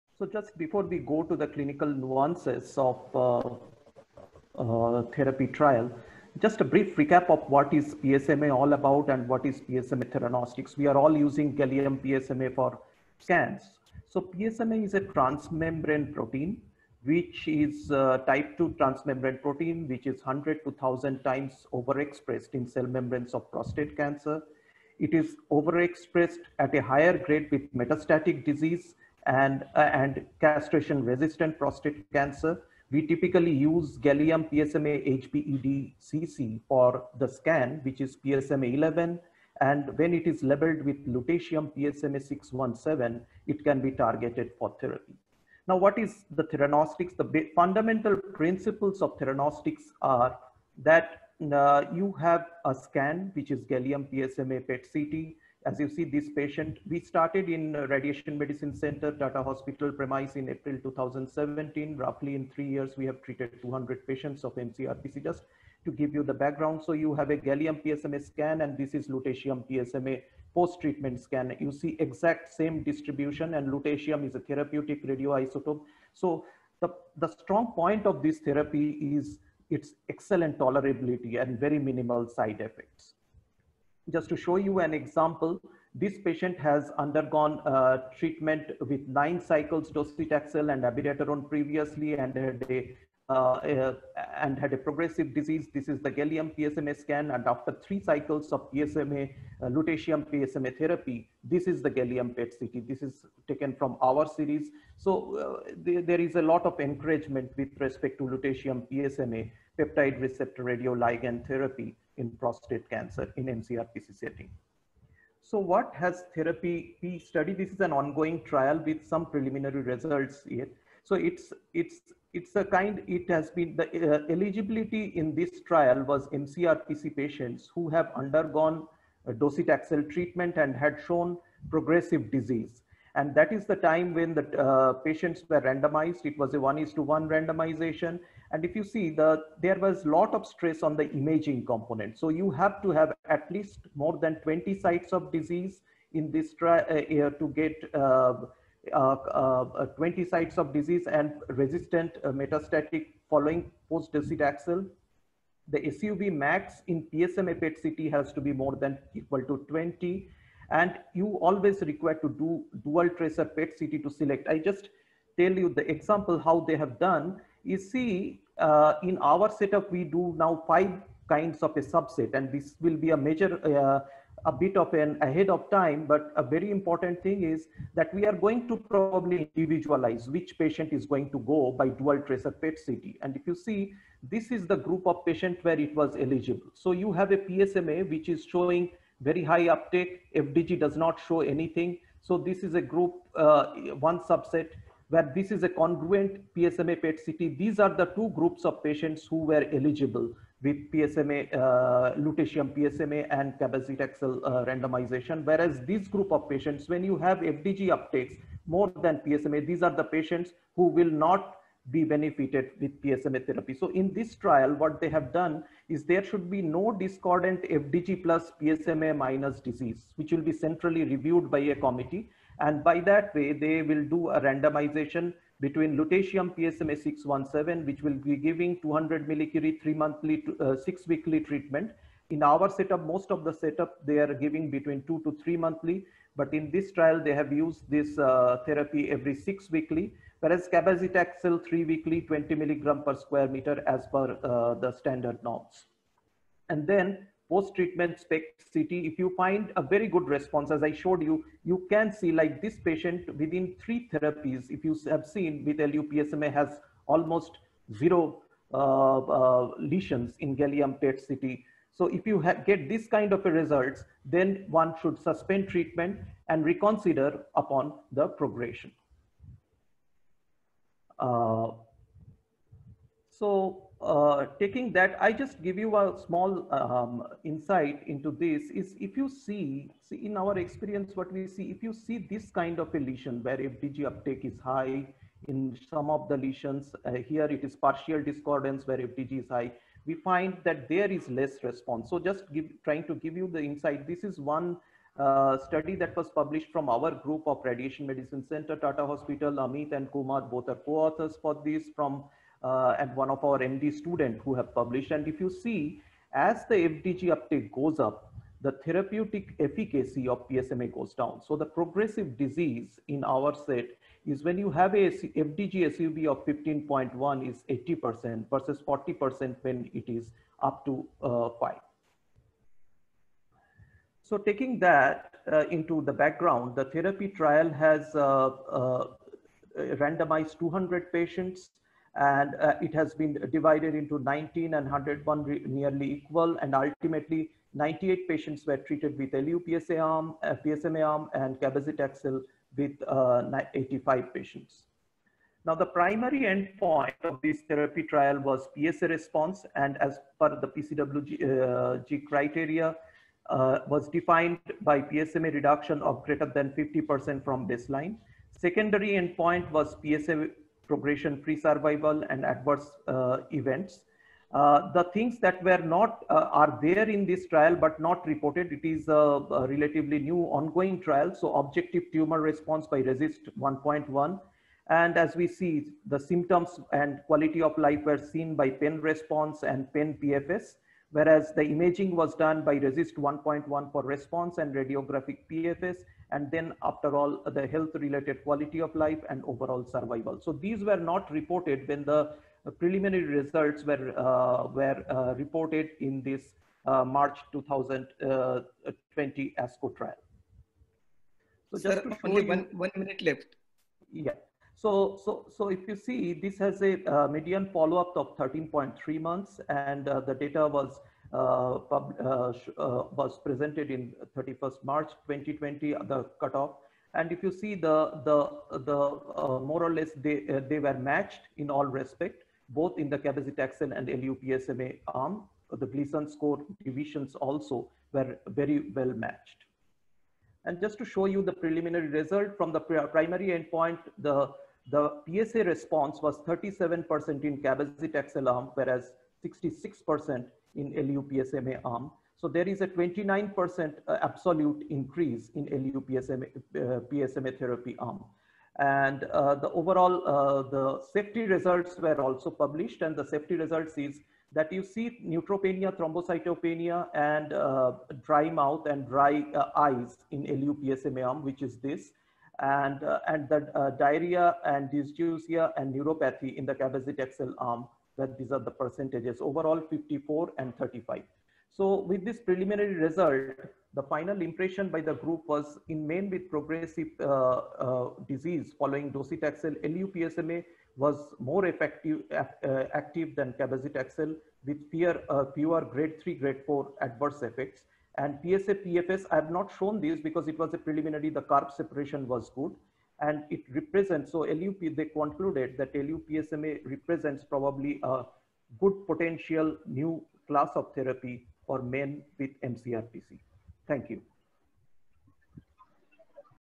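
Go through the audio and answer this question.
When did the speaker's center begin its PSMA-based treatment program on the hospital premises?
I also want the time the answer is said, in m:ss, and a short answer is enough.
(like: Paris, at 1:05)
April 2017, at 1:00.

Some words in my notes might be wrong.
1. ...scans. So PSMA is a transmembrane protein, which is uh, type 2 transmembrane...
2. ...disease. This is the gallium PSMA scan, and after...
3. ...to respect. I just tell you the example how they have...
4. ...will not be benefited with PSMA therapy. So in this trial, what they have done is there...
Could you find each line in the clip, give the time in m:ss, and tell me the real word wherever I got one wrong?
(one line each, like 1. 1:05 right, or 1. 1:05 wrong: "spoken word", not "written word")
1. 0:13 right
2. 1:35 right
3. 2:44 wrong: "select", not "respect"
4. 3:30 right.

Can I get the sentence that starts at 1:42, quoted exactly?
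This is taken from our series.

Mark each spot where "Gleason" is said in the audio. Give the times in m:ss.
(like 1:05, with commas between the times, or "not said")
7:05.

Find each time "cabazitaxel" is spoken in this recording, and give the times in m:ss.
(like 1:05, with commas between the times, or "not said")
3:23, 4:00, 5:41, 7:03, 7:17, 7:46, 8:03.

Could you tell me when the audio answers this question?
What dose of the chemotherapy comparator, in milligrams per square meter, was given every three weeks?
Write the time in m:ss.
4:02.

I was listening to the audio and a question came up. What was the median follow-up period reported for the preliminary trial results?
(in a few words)
13.3 months.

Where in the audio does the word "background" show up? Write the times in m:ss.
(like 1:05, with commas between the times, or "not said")
1:06, 5:26.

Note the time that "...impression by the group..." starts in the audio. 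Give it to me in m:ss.
7:54.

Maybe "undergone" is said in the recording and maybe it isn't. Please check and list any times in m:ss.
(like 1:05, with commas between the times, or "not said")
1:26, 2:08.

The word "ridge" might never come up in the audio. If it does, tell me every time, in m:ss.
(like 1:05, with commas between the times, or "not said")
not said.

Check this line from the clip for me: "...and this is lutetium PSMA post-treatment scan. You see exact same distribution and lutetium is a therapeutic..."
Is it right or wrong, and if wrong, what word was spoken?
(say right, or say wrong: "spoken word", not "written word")
right.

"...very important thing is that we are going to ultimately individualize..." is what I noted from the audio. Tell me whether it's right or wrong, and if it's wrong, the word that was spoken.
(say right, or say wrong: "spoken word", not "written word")
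wrong: "probably", not "ultimately".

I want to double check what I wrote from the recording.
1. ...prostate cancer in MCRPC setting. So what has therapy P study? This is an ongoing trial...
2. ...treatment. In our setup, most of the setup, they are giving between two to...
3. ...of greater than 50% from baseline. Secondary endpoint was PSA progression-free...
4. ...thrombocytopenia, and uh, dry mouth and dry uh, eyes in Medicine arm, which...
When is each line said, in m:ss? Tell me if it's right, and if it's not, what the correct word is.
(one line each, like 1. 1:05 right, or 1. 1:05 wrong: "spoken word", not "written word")
1. 1:52 right
2. 3:51 right
3. 5:56 right
4. 7:35 wrong: "LUPSMA", not "Medicine".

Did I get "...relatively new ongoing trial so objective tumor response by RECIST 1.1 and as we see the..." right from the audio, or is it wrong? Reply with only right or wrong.
right.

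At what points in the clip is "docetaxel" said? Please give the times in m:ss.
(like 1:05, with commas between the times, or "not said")
1:29, 2:09, 2:33, 7:59.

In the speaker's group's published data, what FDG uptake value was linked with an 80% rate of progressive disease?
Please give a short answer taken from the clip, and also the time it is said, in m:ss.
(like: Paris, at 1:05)
15.1, at 5:16.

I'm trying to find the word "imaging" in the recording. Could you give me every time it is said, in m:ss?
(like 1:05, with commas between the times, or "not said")
2:21, 6:21.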